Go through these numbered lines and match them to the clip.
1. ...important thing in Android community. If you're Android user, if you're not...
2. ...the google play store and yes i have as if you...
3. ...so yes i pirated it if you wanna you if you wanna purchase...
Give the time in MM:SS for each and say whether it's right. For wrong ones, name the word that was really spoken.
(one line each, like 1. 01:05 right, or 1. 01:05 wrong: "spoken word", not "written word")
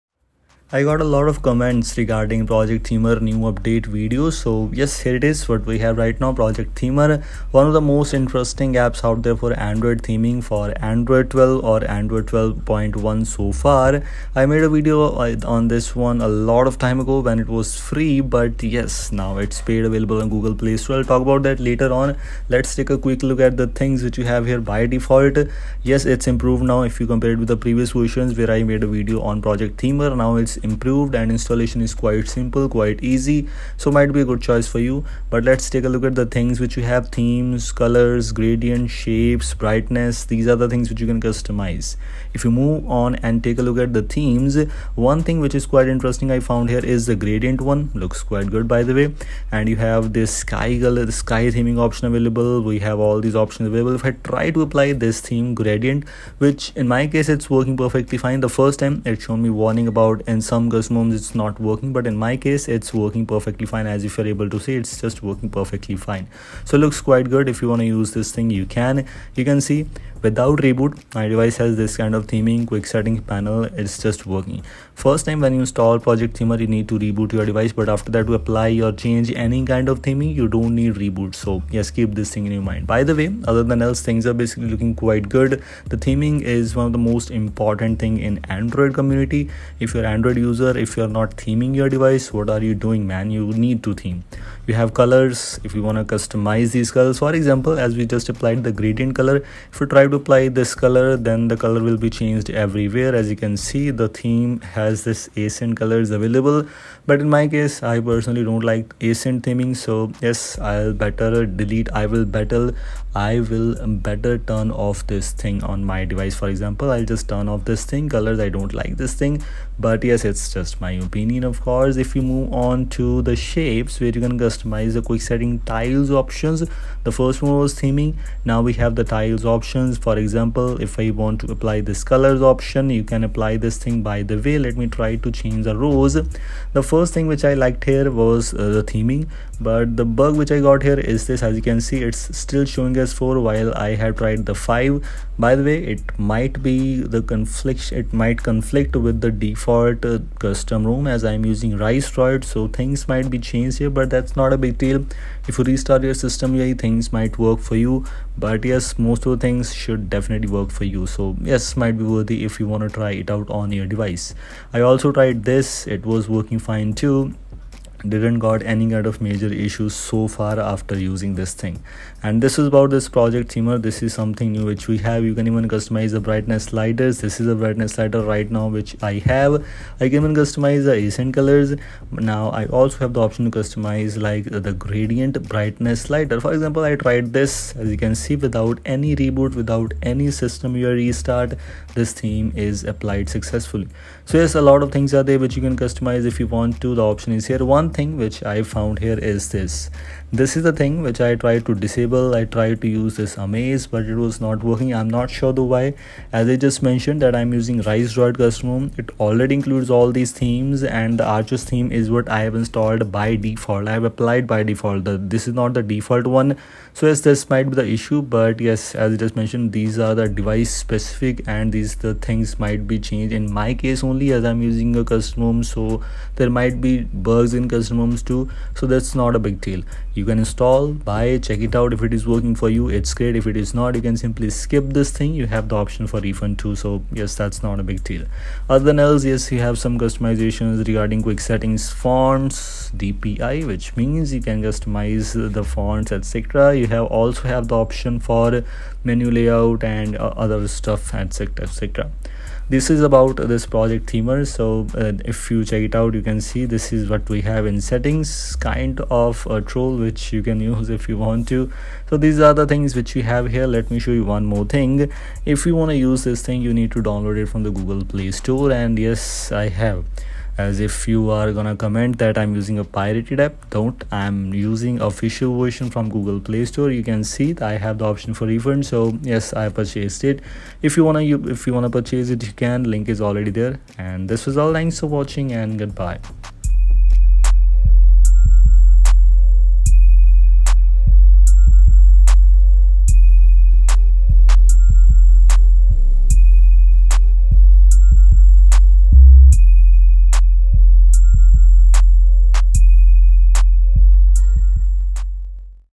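1. 01:27 right
2. 04:27 right
3. 04:38 wrong: "purchased", not "pirated".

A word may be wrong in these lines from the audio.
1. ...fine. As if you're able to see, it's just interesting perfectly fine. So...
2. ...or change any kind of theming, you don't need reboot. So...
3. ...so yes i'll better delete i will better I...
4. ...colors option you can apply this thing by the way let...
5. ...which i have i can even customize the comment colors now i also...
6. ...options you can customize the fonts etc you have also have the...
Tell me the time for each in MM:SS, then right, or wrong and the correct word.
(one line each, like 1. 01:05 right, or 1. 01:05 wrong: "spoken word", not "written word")
1. 01:03 wrong: "working", not "interesting"
2. 01:18 right
3. 01:49 right
4. 02:12 right
5. 02:58 wrong: "accent", not "comment"
6. 04:03 wrong: "means", not "options".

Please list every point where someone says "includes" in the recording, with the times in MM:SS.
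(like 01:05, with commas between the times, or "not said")
03:29.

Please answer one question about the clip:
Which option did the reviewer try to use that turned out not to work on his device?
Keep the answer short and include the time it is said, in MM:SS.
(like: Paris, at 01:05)
Amaze, at 03:23.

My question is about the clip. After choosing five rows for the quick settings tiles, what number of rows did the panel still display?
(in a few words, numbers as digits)
4.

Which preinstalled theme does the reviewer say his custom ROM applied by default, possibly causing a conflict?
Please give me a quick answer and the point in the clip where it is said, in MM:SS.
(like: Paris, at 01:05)
Arches, at 03:31.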